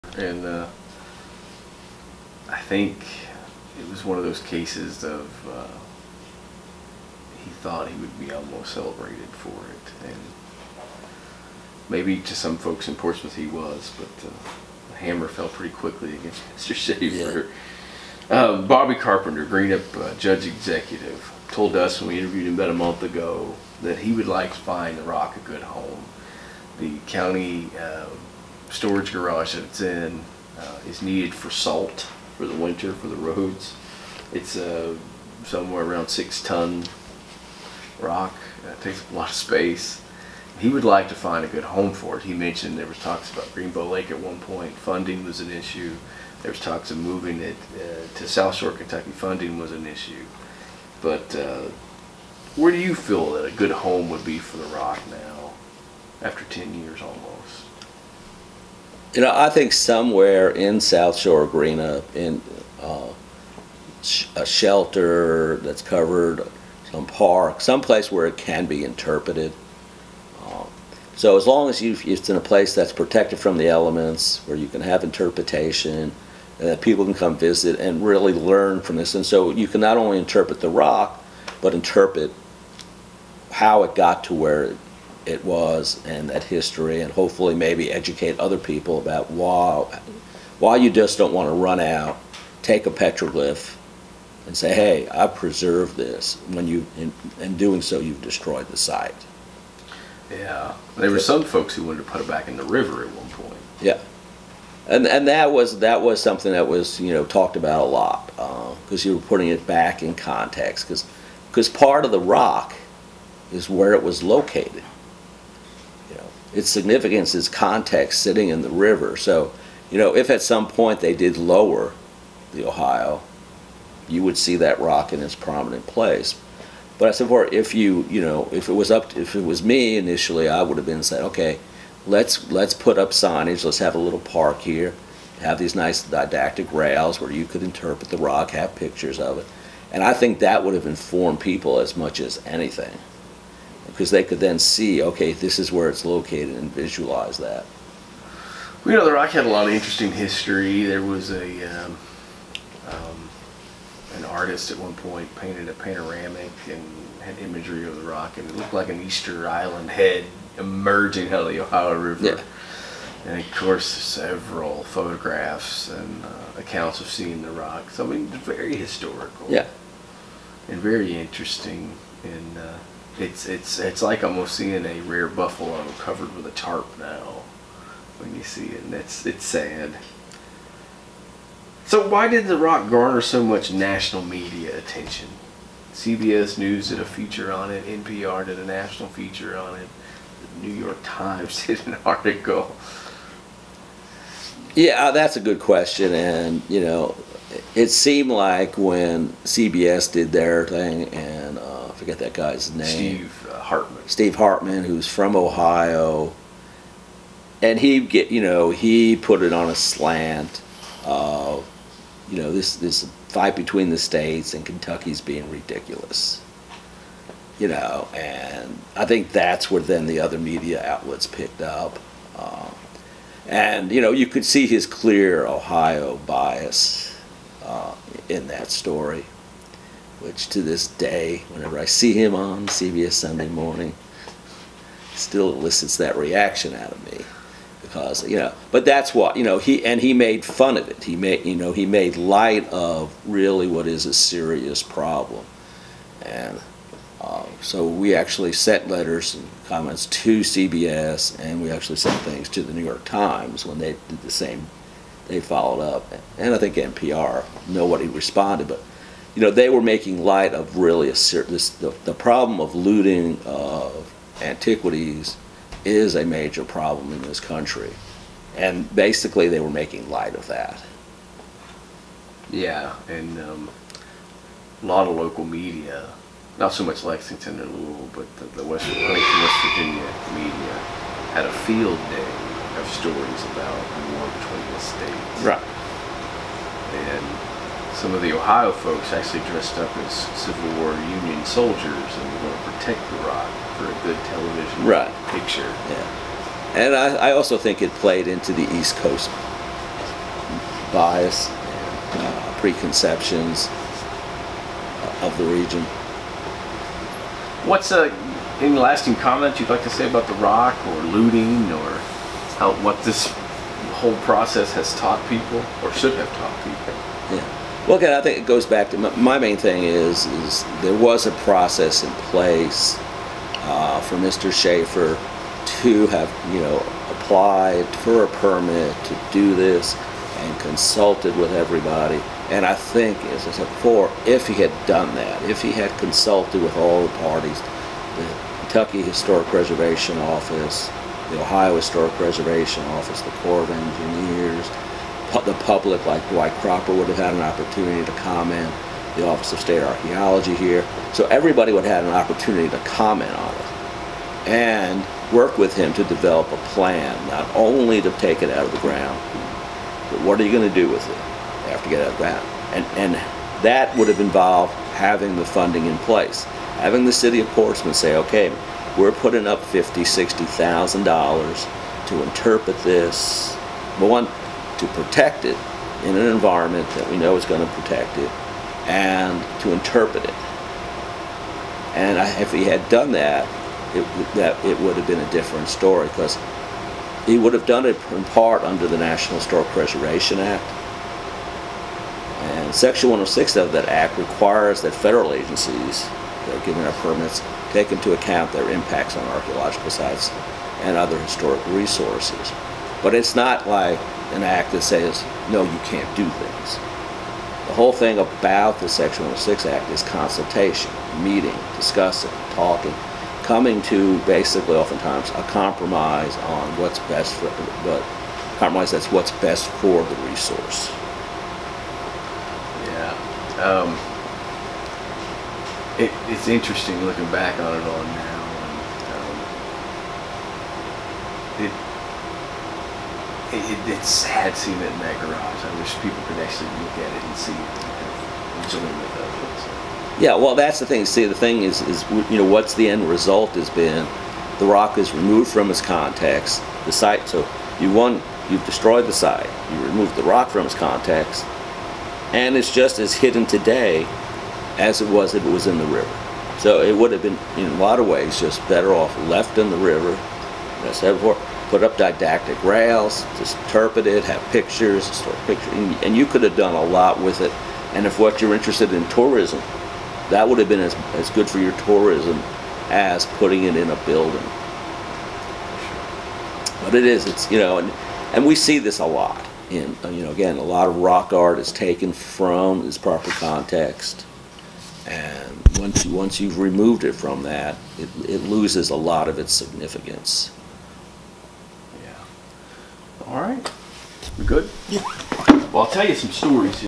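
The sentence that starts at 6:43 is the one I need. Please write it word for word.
But it's not like an act that says, no, you can't do things.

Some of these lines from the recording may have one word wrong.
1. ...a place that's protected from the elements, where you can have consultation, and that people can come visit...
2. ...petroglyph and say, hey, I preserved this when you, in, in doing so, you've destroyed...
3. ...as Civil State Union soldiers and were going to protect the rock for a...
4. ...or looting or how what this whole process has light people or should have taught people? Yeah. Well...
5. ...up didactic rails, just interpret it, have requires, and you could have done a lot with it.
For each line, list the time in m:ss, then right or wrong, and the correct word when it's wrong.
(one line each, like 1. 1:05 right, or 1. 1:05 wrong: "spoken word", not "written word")
1. 1:12 wrong: "interpretation", not "consultation"
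2. 1:32 right
3. 4:49 wrong: "War", not "State"
4. 5:10 wrong: "taught", not "light"
5. 7:41 wrong: "pictures", not "requires".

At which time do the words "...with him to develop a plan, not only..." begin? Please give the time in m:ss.
5:55.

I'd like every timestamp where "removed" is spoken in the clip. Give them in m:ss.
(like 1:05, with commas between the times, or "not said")
7:25, 7:29, 8:06.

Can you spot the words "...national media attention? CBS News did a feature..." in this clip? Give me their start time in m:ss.
3:03.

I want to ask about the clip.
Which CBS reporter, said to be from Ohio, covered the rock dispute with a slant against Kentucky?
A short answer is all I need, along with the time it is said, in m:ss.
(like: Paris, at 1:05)
Steve Hartman, at 3:24.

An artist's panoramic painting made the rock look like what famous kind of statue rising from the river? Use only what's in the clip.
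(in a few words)
Easter Island head.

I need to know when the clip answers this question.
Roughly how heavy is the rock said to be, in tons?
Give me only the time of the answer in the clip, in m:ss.
0:36.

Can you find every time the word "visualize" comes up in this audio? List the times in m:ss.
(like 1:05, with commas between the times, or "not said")
2:26.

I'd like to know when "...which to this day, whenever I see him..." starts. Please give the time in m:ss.
3:50.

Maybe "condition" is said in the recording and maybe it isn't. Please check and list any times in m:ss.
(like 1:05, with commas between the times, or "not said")
not said.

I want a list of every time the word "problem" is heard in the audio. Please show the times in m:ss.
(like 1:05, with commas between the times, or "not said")
4:04, 4:22, 4:26.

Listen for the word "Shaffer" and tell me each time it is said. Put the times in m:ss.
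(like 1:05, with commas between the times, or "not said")
0:16, 5:24.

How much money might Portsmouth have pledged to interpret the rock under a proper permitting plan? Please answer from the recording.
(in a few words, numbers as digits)
$50,000 to $60,000.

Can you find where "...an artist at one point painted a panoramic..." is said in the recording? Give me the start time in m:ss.
2:34.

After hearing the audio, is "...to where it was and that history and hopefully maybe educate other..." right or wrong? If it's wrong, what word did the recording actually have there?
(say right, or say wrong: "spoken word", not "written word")
right.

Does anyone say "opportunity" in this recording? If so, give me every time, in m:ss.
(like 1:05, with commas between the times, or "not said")
5:47, 5:52.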